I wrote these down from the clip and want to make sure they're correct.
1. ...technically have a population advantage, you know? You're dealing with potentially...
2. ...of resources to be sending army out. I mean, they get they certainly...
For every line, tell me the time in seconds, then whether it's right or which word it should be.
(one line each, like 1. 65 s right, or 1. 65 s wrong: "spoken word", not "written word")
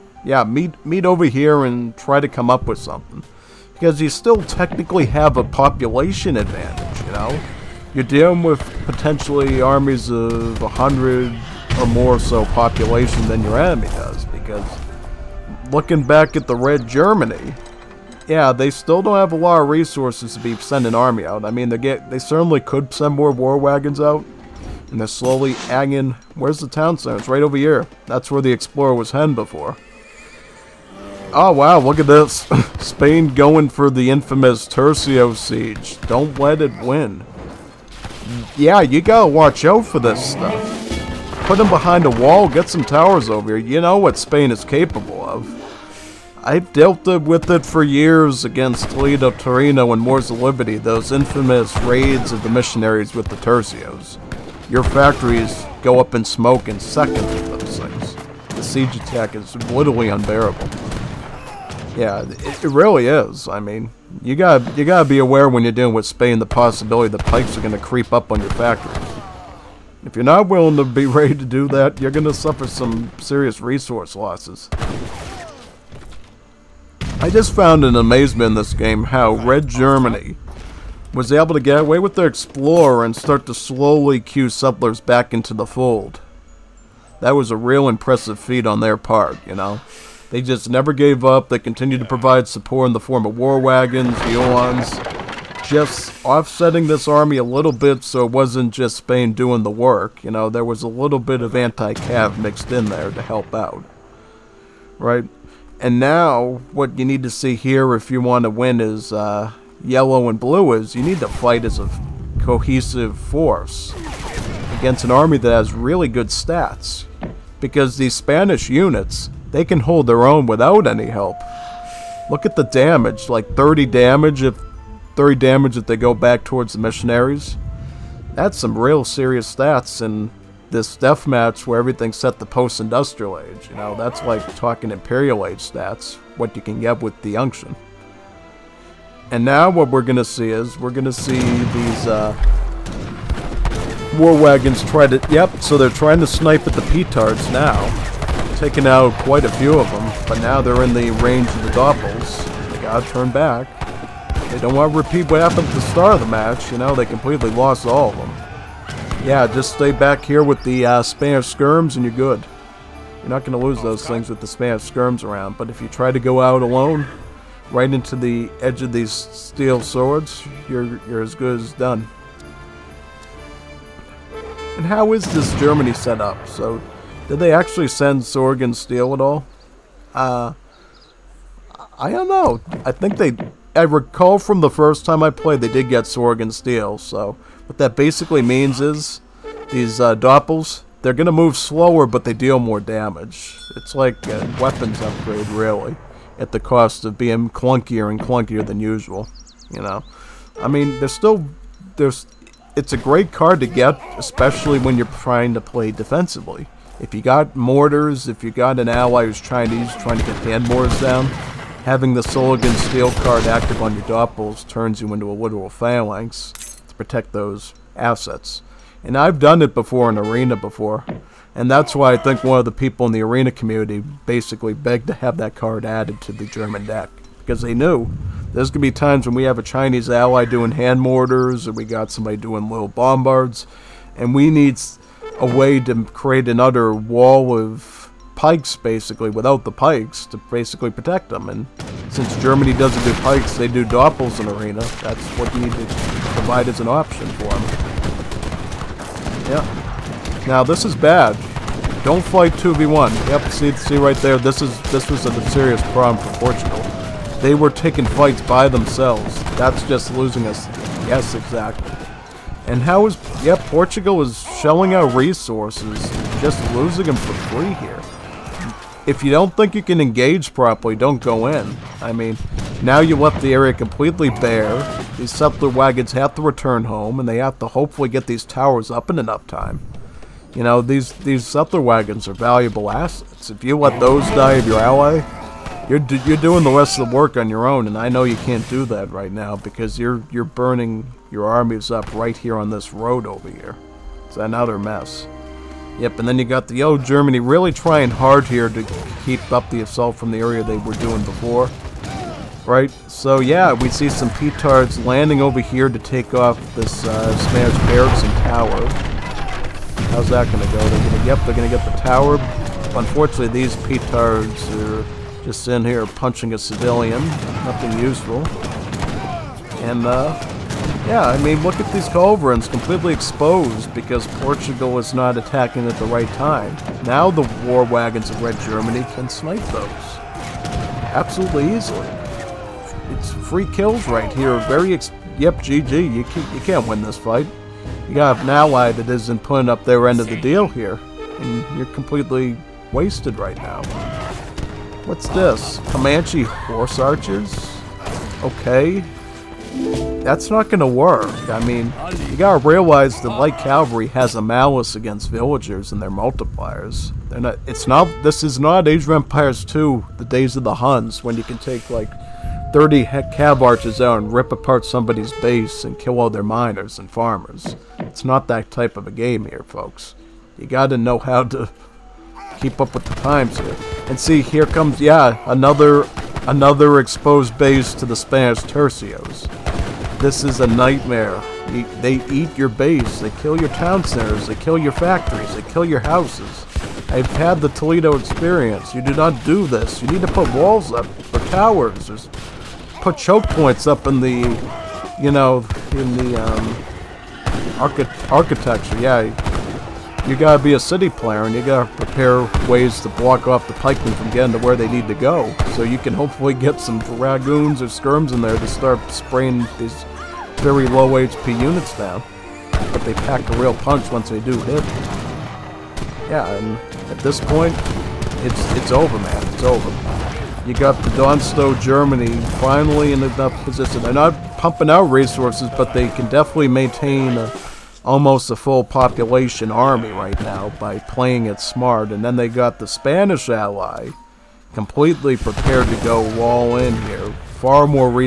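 1. 4 s right
2. 19 s right.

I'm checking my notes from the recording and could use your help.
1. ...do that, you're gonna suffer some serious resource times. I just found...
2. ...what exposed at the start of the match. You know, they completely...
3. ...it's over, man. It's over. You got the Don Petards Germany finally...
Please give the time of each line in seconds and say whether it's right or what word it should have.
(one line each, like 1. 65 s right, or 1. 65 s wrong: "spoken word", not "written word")
1. 71 s wrong: "losses", not "times"
2. 155 s wrong: "happened", not "exposed"
3. 418 s wrong: "Stowe", not "Petards".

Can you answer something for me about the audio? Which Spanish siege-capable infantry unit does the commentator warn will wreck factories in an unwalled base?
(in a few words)
Tercio.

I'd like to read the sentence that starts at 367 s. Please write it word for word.
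It's not that type of a game here, folks.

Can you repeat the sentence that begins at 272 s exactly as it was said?
I mean, now you left the area completely bare.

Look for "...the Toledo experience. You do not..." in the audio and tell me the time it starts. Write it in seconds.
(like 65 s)
387 s.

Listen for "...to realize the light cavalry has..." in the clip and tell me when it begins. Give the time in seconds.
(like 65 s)
352 s.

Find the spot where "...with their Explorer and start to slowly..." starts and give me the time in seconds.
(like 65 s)
81 s.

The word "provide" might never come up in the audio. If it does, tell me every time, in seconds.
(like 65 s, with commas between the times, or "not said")
92 s, 246 s.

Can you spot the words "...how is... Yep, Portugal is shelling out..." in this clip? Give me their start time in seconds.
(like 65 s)
262 s.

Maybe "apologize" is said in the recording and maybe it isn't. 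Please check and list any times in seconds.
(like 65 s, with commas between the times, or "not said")
not said.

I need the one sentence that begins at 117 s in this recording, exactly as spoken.
Because these Spanish units, they can hold their own without any help.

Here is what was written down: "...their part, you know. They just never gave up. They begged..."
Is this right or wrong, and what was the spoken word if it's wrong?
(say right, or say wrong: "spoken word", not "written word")
wrong: "continued", not "begged".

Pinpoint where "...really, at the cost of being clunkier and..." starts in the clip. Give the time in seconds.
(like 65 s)
195 s.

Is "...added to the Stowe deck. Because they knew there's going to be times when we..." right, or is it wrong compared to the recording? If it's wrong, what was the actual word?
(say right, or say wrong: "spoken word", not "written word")
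wrong: "German", not "Stowe".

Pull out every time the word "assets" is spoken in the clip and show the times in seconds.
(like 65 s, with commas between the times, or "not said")
217 s, 282 s.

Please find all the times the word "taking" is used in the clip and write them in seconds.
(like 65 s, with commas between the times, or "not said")
148 s, 257 s.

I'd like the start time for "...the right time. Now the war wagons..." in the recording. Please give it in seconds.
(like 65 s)
325 s.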